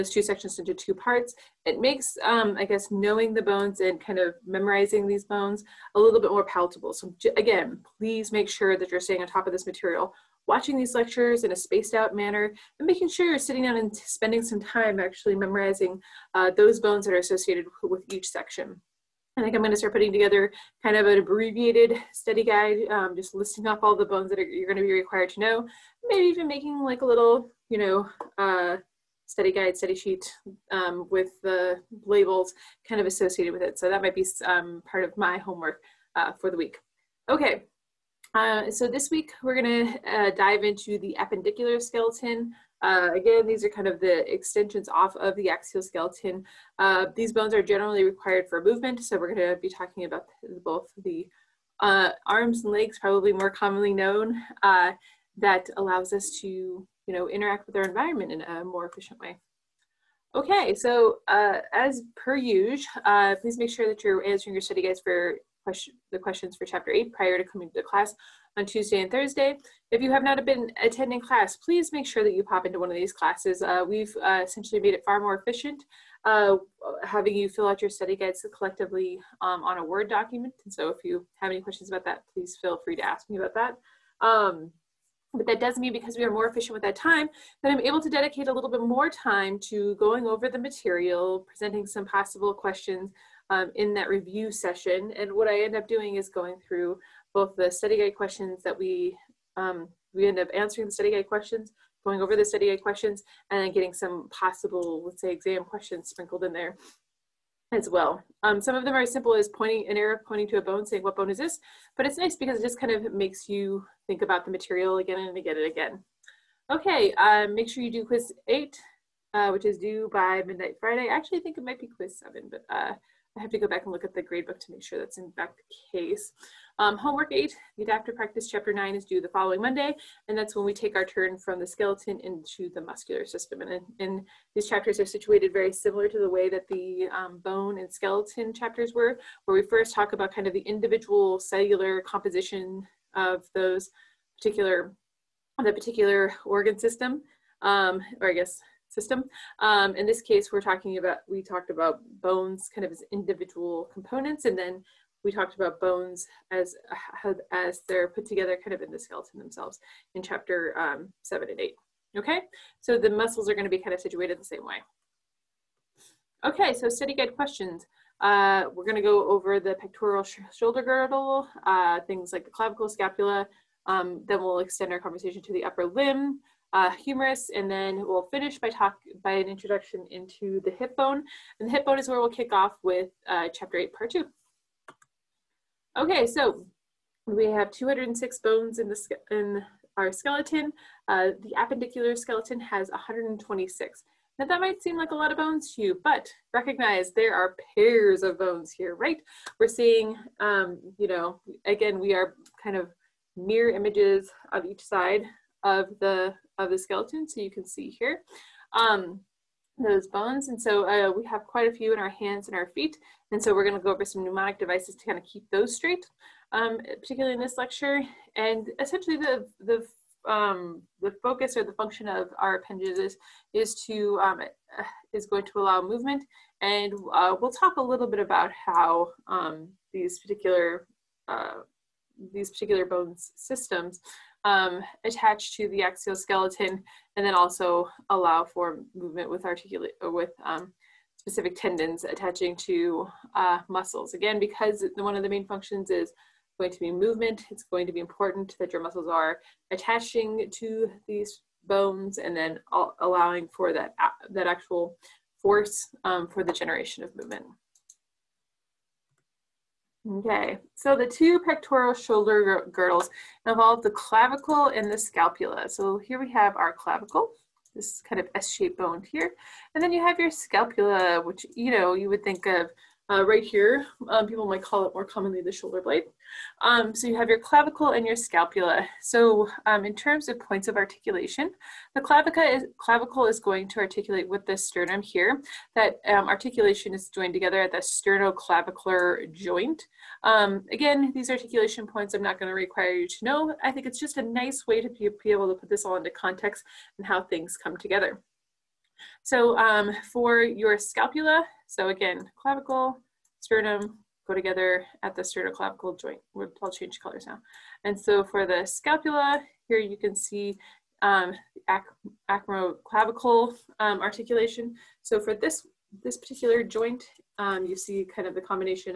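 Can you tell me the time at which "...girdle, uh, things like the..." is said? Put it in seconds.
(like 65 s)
170 s.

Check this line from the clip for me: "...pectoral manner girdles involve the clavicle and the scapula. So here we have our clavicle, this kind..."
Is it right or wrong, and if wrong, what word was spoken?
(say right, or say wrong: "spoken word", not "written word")
wrong: "shoulder", not "manner".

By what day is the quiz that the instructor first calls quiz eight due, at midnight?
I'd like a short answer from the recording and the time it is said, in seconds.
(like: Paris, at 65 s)
Friday, at 120 s.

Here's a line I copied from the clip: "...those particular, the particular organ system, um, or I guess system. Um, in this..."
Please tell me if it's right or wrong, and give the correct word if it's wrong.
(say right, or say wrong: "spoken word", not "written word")
right.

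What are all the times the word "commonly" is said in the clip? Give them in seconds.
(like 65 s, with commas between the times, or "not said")
53 s, 275 s.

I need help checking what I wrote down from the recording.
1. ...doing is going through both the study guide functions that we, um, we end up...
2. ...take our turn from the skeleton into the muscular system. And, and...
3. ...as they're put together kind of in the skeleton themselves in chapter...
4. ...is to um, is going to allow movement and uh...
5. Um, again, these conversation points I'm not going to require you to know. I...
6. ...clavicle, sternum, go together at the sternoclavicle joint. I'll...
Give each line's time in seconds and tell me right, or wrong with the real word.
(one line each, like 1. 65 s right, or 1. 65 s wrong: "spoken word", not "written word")
1. 95 s wrong: "questions", not "functions"
2. 130 s right
3. 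157 s right
4. 223 s right
5. 290 s wrong: "articulation", not "conversation"
6. 302 s right.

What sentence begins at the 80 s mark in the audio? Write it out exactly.
And so if you have any questions about that, please feel free to ask me about that.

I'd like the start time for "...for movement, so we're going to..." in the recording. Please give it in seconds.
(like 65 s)
48 s.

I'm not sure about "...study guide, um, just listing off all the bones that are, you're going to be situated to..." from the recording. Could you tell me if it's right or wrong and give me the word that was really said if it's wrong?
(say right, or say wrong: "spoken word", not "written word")
wrong: "required", not "situated".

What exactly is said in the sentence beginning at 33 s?
So that might be um, part of my homework uh, for the week.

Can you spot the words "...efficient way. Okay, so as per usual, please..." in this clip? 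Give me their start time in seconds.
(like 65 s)
58 s.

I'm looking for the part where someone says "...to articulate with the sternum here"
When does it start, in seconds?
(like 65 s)
283 s.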